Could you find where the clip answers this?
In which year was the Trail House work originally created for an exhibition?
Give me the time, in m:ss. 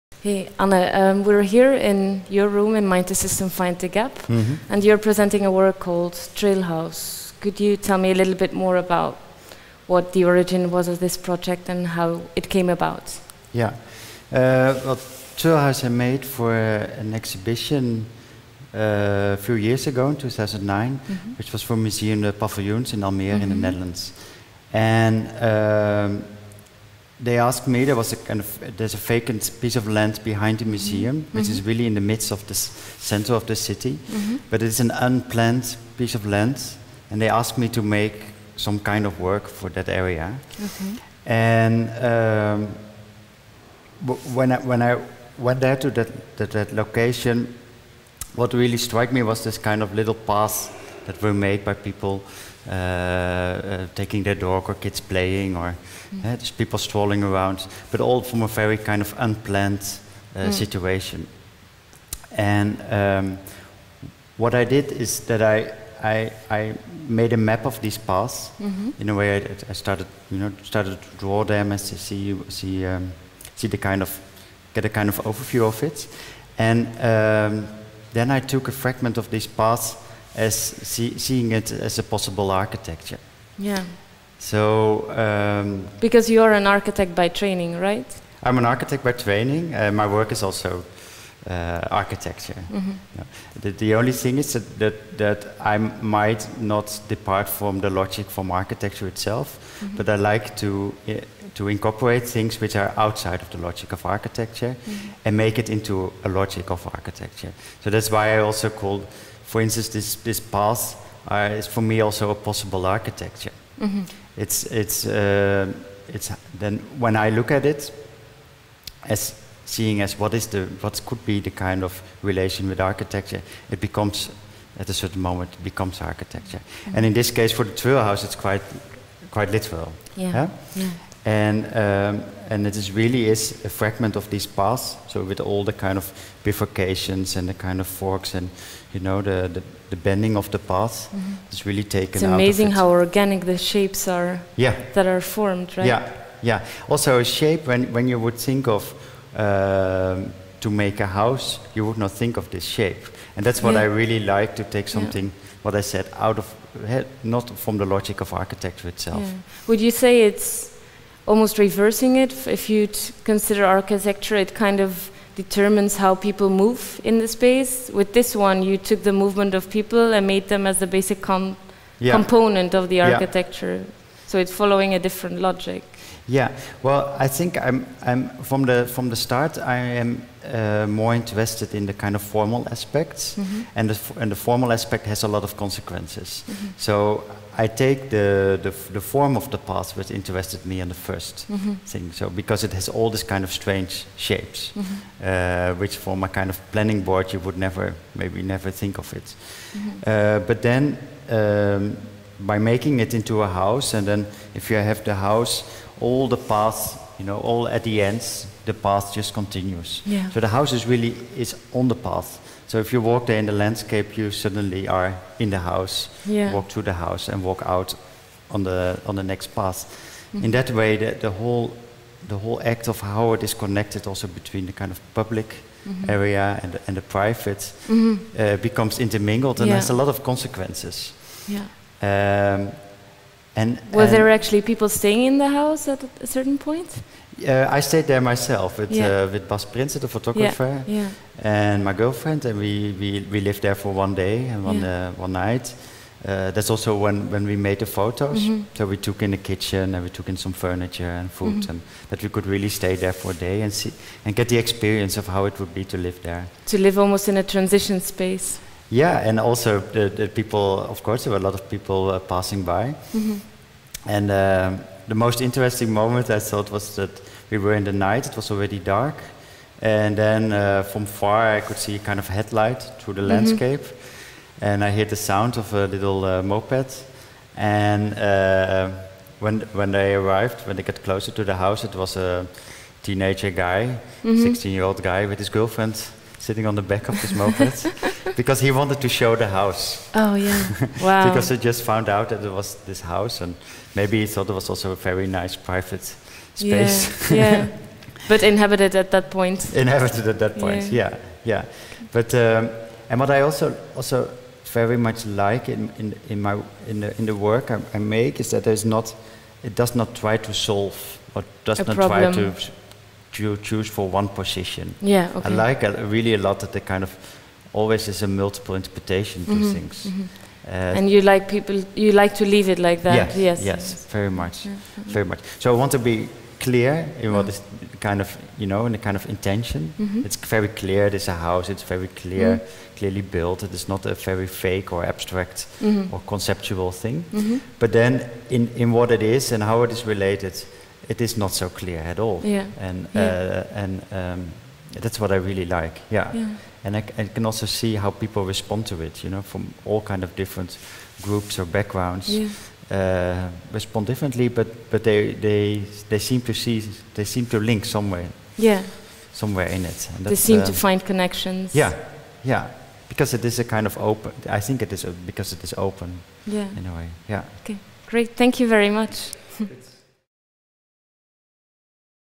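0:20.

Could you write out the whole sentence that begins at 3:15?
uh, which form a kind of planning board you would never maybe never think of it.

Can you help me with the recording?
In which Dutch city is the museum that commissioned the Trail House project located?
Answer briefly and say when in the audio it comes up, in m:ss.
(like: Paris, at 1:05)
Almere, at 0:23.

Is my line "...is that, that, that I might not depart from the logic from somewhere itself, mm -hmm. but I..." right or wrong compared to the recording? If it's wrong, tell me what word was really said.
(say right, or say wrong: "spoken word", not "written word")
wrong: "architecture", not "somewhere".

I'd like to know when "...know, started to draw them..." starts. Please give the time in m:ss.
1:10.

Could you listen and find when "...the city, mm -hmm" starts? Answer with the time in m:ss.
0:33.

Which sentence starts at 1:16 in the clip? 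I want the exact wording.
And um, then I took a fragment of these paths as see, seeing it as a possible architecture.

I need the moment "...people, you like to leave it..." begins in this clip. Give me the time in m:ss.
5:21.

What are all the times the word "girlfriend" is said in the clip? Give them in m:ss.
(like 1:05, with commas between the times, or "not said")
4:01, 4:45.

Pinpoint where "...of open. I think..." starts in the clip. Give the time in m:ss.
6:03.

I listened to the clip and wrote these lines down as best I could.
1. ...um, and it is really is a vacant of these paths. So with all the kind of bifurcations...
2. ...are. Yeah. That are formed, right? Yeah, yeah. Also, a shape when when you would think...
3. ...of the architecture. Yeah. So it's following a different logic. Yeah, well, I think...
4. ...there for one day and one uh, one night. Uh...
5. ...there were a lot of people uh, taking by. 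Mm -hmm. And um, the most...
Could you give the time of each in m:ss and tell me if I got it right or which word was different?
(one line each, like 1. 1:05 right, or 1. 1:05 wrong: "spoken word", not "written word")
1. 2:11 wrong: "fragment", not "vacant"
2. 2:24 right
3. 2:52 right
4. 4:03 right
5. 4:21 wrong: "passing", not "taking".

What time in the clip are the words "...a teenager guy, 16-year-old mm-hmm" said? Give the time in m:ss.
4:42.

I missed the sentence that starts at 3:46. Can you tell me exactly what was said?
area and the, and the private mm-hmm.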